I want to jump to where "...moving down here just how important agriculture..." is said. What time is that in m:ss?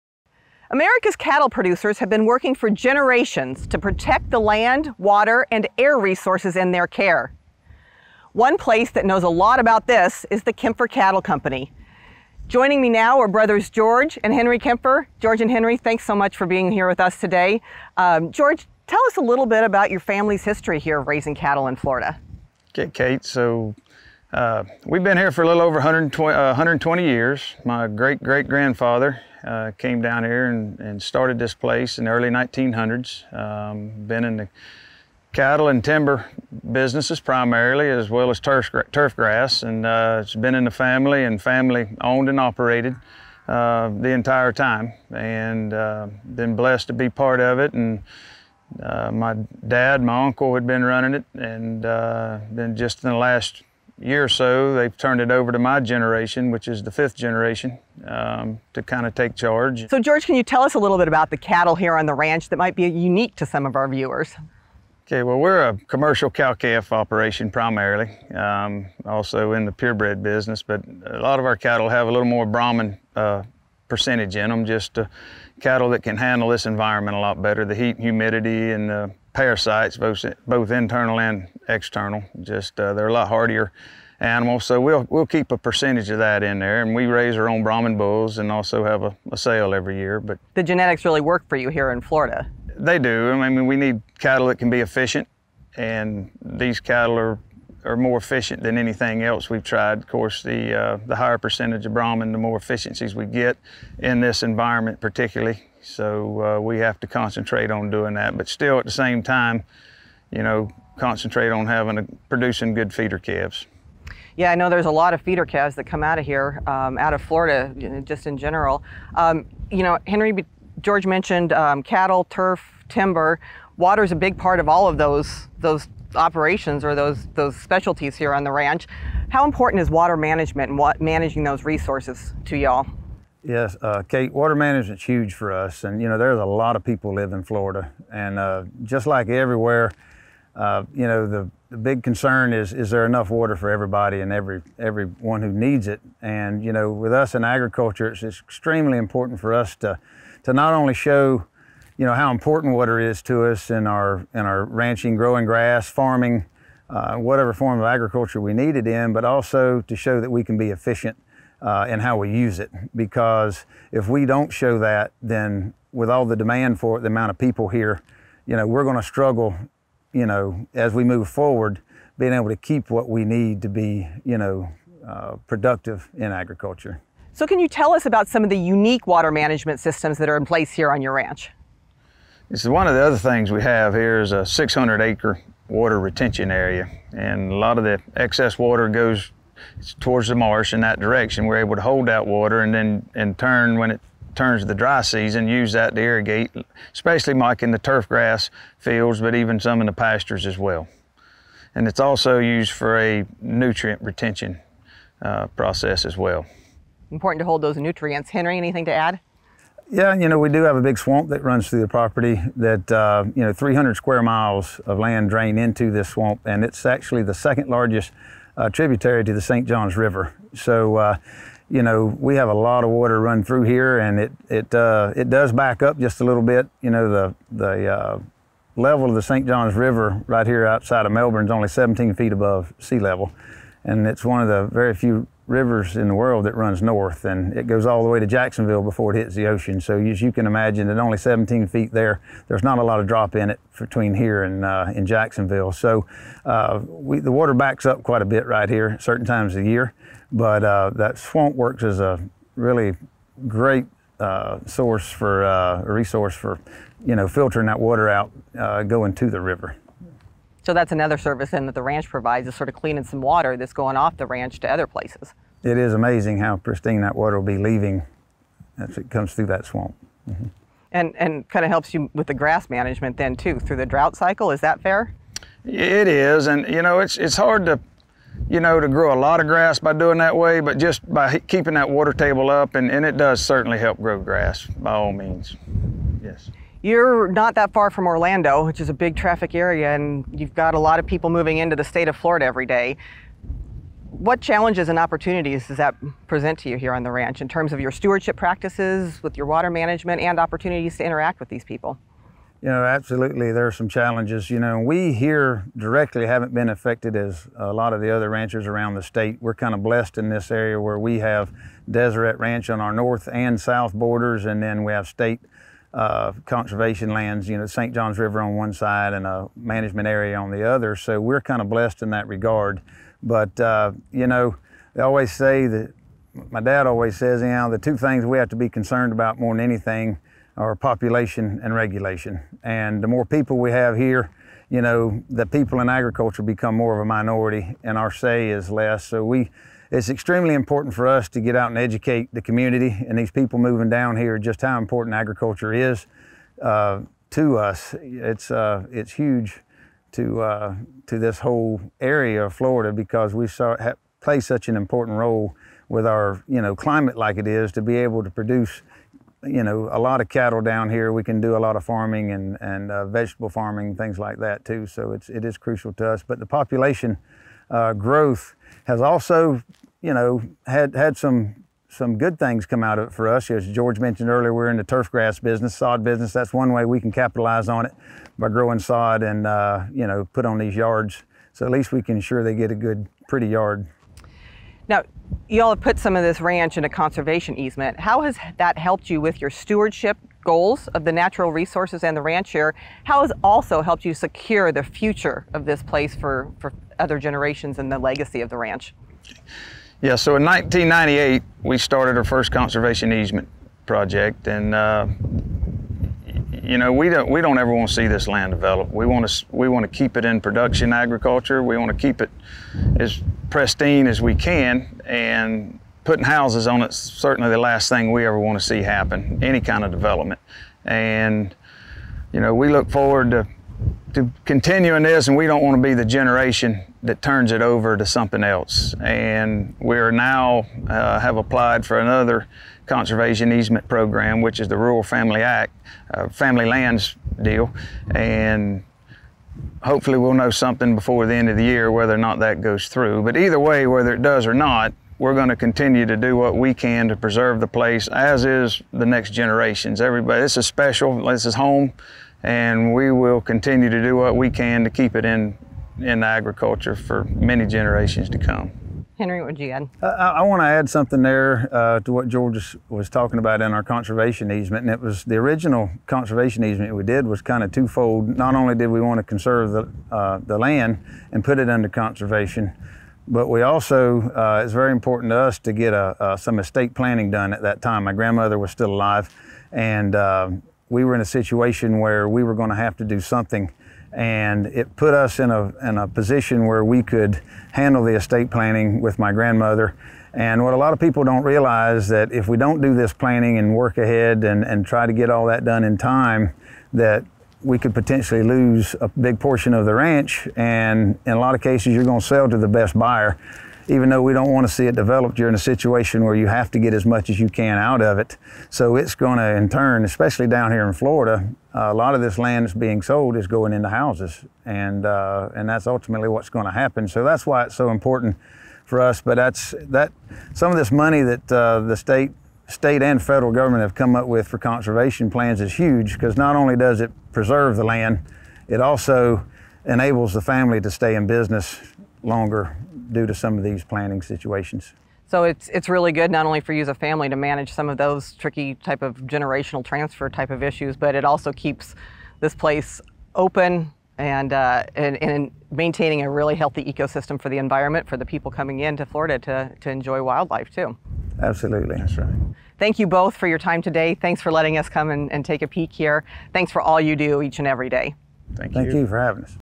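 5:43.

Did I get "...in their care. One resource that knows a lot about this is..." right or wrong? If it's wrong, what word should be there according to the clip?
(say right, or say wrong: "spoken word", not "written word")
wrong: "place", not "resource".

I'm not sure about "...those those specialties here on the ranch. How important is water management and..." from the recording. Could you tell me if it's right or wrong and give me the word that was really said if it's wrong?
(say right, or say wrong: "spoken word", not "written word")
right.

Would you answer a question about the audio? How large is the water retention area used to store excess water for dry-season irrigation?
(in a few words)
600 acres.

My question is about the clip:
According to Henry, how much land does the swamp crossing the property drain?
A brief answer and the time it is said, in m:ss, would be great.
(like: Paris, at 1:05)
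300 square miles, at 3:33.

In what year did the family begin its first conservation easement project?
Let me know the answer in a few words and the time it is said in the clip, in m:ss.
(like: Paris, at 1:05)
1998, at 6:40.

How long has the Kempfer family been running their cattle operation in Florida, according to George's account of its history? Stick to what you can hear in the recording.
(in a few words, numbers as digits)
120 years.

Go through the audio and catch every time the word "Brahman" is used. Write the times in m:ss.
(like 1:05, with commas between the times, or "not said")
1:12, 1:27, 1:41.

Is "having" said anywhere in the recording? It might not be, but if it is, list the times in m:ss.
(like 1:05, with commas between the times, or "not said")
1:51, 9:19.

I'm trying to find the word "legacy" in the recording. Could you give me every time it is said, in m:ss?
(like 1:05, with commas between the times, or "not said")
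6:37.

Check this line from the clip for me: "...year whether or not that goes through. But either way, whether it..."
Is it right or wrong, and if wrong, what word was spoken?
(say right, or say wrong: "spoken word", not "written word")
right.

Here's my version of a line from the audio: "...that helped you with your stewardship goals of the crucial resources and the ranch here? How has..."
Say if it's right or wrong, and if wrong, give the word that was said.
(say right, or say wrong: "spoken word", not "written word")
wrong: "natural", not "crucial".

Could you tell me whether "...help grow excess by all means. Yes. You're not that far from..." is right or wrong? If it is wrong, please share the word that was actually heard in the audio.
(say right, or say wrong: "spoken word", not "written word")
wrong: "grass", not "excess".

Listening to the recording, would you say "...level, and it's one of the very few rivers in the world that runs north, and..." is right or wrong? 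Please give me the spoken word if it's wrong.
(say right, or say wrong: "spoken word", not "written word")
right.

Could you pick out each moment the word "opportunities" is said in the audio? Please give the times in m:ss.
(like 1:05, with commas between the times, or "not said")
4:54, 5:00.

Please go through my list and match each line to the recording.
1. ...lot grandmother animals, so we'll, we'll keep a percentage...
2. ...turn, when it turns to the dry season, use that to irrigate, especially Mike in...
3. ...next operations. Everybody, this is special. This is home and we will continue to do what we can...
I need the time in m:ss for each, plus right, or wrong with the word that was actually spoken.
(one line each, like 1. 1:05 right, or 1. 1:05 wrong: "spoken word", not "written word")
1. 1:23 wrong: "hardier", not "grandmother"
2. 3:13 right
3. 7:29 wrong: "generations", not "operations".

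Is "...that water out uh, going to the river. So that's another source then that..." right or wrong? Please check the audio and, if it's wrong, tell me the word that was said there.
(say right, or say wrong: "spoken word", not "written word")
wrong: "service", not "source".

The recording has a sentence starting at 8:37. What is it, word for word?
So that's why it's so important for us.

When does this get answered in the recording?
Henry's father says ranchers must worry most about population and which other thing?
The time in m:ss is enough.
5:31.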